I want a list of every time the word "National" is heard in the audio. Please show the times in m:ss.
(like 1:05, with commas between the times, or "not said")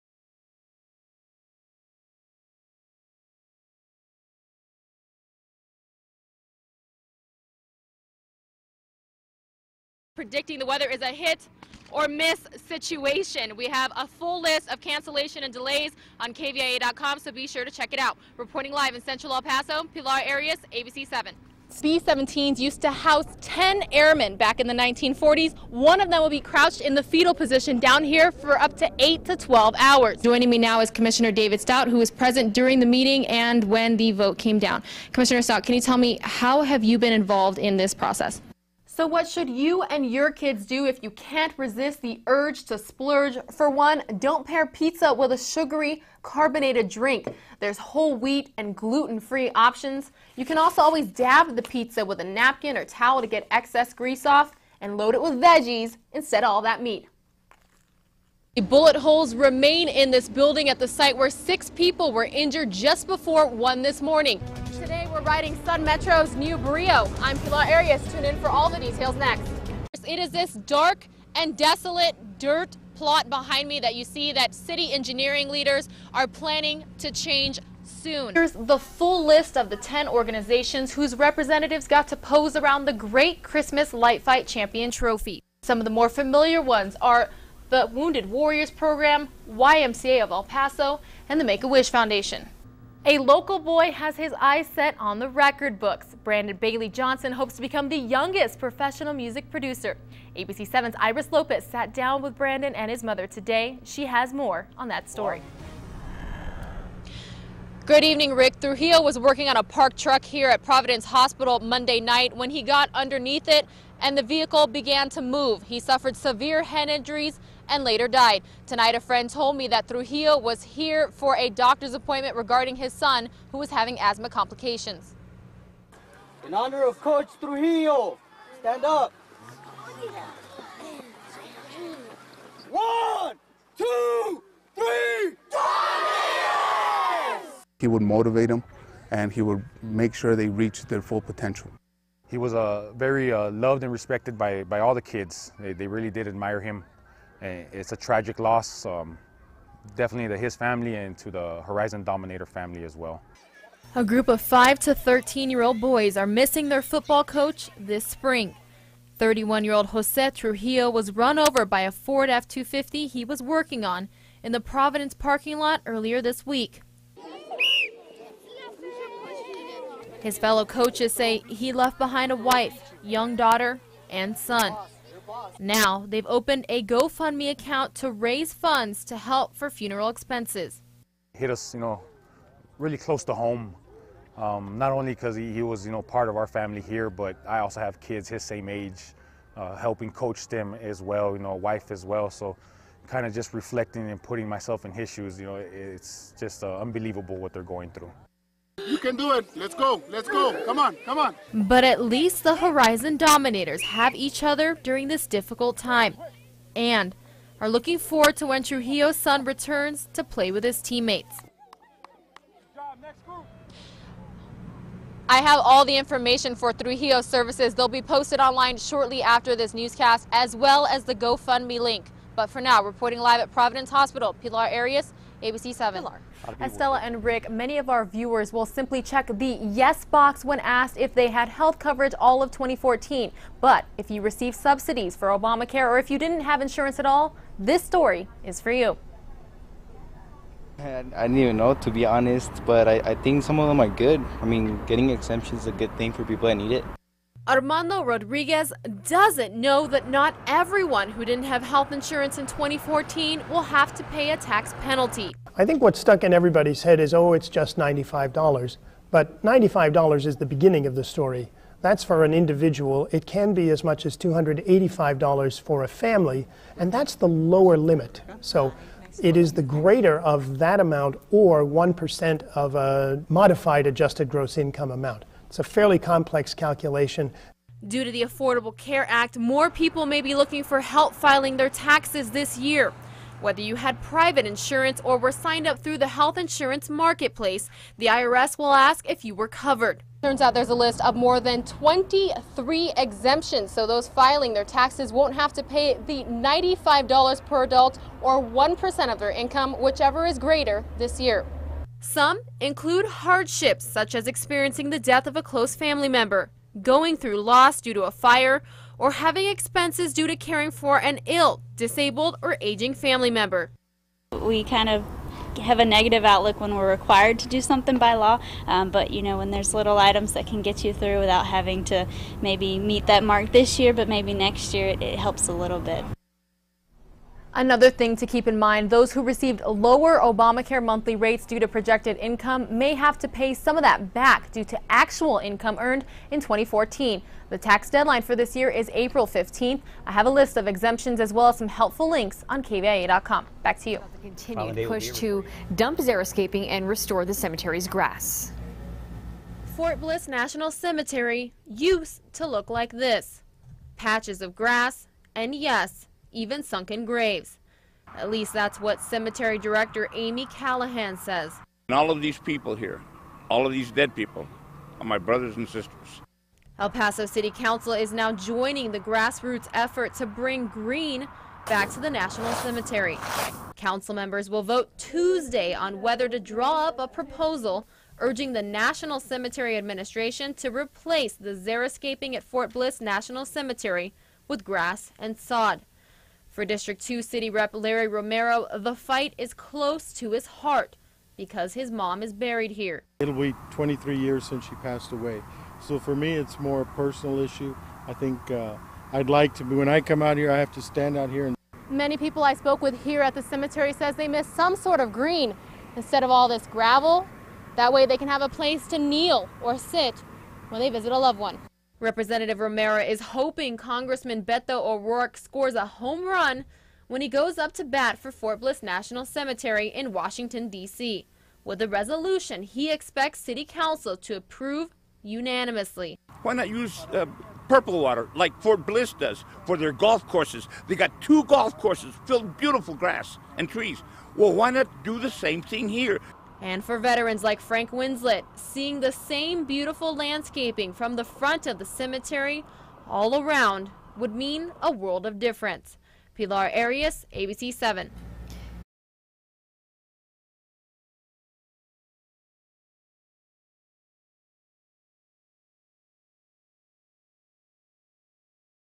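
5:50, 6:12, 6:18, 6:22, 6:58.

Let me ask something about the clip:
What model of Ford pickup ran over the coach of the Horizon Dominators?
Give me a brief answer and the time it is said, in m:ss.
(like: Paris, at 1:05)
F 250, at 2:42.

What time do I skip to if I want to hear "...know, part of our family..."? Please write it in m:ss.
3:05.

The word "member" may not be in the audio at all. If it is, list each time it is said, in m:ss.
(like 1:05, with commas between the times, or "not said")
5:06, 5:13, 6:14.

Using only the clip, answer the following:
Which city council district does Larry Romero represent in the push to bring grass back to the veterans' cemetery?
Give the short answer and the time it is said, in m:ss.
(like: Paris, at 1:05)
District 2, at 6:26.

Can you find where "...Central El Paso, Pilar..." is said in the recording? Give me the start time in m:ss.
0:19.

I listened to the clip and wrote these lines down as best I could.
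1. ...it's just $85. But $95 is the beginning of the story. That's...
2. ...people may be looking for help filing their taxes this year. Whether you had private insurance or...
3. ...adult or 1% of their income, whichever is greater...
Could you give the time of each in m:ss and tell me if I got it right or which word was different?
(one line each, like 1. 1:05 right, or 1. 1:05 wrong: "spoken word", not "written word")
1. 4:17 wrong: "95", not "85"
2. 4:39 right
3. 4:57 right.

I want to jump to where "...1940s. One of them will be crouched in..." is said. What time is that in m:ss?
0:24.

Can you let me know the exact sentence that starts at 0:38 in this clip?
So, what should you and your kids do if you can't resist the urge to splurge?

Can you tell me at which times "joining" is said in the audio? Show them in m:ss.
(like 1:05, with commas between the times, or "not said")
0:30, 6:08.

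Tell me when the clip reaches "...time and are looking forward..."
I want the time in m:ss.
3:25.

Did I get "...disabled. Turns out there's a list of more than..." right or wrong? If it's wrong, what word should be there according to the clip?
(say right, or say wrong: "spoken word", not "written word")
wrong: "covered", not "disabled".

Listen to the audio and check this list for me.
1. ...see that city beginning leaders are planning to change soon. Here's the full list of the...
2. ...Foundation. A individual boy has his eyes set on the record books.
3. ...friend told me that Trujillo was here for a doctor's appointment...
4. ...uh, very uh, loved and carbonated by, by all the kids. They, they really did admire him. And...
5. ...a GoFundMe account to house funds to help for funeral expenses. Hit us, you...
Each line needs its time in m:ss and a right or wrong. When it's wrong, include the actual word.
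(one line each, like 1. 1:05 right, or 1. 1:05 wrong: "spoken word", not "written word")
1. 1:14 wrong: "engineering", not "beginning"
2. 1:31 wrong: "local", not "individual"
3. 1:58 right
4. 2:22 wrong: "respected", not "carbonated"
5. 2:56 wrong: "raise", not "house".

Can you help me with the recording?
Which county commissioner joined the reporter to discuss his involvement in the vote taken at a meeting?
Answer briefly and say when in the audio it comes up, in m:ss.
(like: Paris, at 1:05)
David Stout, at 0:31.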